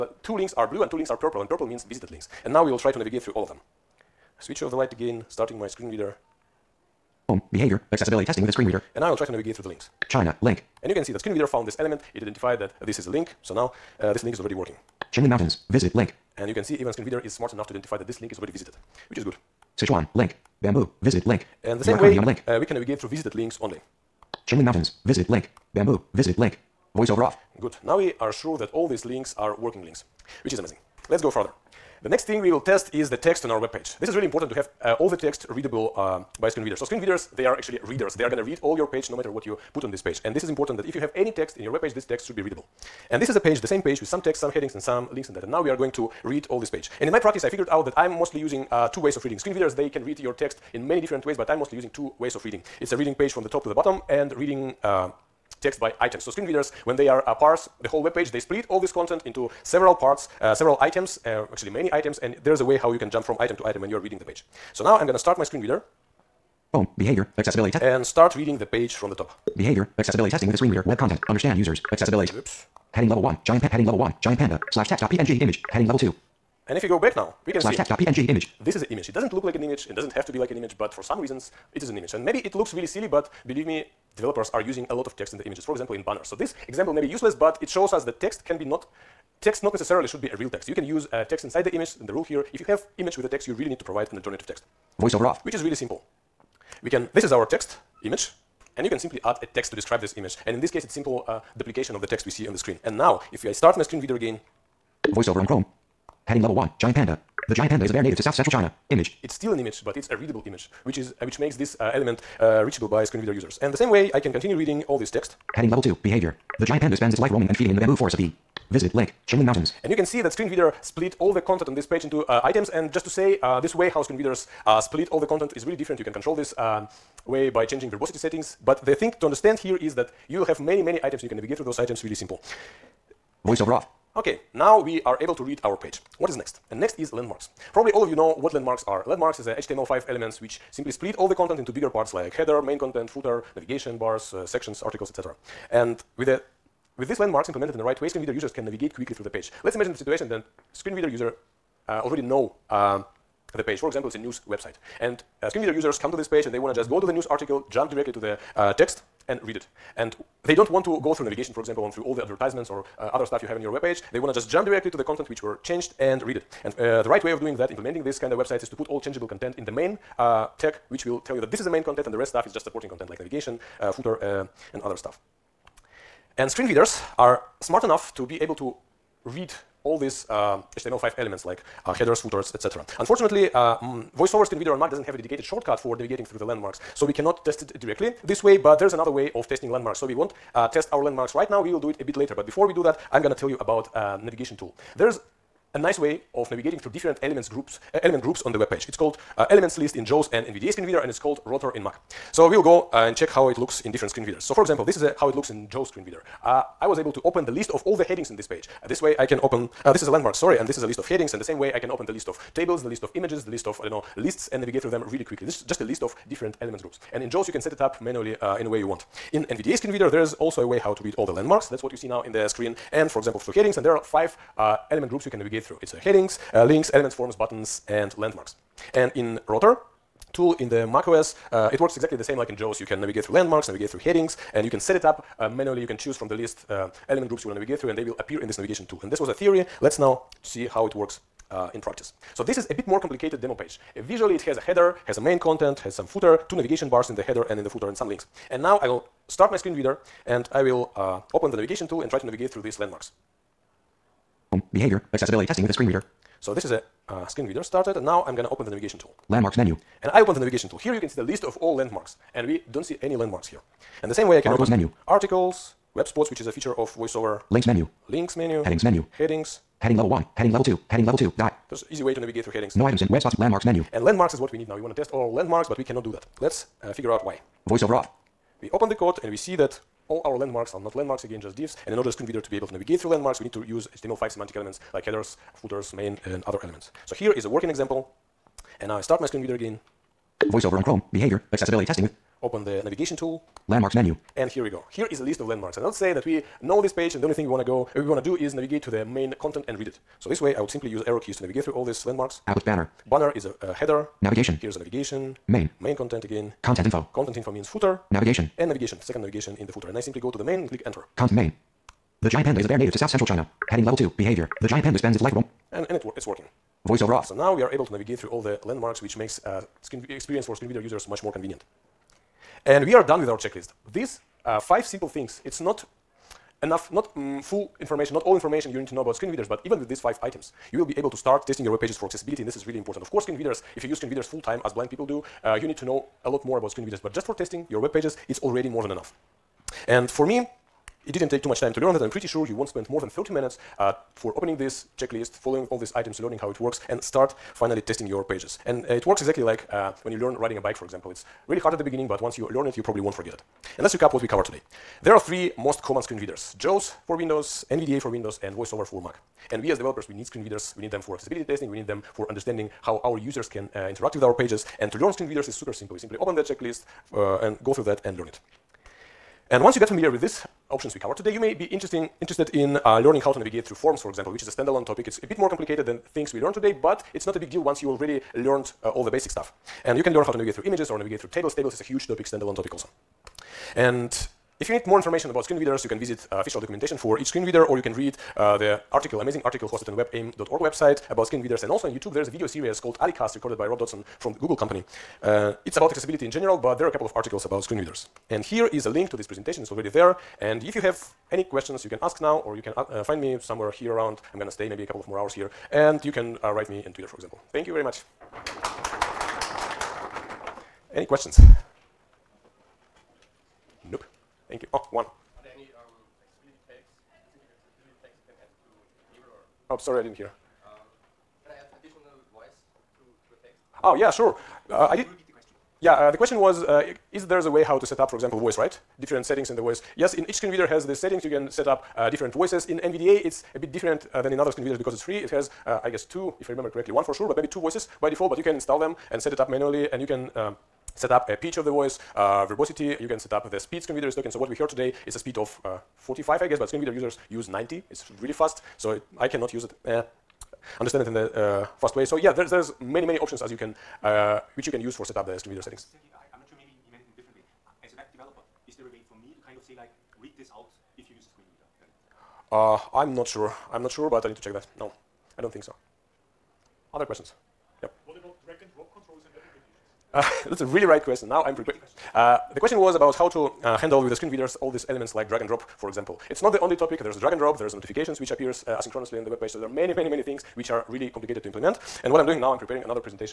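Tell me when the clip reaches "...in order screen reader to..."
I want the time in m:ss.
4:41.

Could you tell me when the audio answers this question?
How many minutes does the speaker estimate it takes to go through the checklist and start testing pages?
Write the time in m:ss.
5:43.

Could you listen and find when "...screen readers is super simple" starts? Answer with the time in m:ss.
6:05.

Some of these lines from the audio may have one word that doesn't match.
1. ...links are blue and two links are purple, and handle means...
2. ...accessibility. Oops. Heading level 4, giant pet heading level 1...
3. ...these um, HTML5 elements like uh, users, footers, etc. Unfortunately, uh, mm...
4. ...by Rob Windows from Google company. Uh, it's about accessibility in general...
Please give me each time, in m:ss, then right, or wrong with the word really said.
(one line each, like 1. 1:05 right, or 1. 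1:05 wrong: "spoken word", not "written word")
1. 0:00 wrong: "purple", not "handle"
2. 1:11 wrong: "1", not "4"
3. 2:59 wrong: "headers", not "users"
4. 6:33 wrong: "Dodson", not "Windows".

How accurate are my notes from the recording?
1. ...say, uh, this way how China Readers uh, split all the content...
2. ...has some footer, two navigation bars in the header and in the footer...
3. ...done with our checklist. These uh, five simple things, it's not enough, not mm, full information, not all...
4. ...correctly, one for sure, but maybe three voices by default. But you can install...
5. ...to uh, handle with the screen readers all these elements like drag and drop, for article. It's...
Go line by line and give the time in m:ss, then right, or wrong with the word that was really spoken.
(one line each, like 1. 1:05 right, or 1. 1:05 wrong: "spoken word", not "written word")
1. 2:03 wrong: "Screen", not "China"
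2. 4:05 right
3. 5:23 right
4. 7:16 wrong: "two", not "three"
5. 7:53 wrong: "example", not "article".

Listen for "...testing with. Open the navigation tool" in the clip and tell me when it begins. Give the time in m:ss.
4:51.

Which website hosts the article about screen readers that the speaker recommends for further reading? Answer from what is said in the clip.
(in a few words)
webaim.org.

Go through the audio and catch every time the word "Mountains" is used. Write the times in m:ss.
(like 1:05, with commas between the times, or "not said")
0:15, 0:24, 1:59.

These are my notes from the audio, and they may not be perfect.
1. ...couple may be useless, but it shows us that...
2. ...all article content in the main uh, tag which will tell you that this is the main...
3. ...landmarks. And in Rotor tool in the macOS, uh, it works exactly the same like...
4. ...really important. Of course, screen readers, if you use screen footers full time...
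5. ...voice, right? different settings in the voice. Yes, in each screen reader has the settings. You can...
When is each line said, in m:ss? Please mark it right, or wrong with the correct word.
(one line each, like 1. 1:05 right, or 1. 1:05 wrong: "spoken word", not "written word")
1. 1:26 wrong: "example", not "couple"
2. 2:48 wrong: "changeable", not "article"
3. 3:48 right
4. 5:32 wrong: "readers", not "footers"
5. 7:08 right.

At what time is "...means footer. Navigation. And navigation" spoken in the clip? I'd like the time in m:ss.
5:07.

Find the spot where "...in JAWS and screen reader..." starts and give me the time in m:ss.
3:19.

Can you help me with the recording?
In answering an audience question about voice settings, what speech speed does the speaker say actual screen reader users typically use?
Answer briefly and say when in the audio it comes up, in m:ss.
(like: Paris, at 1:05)
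90, at 7:27.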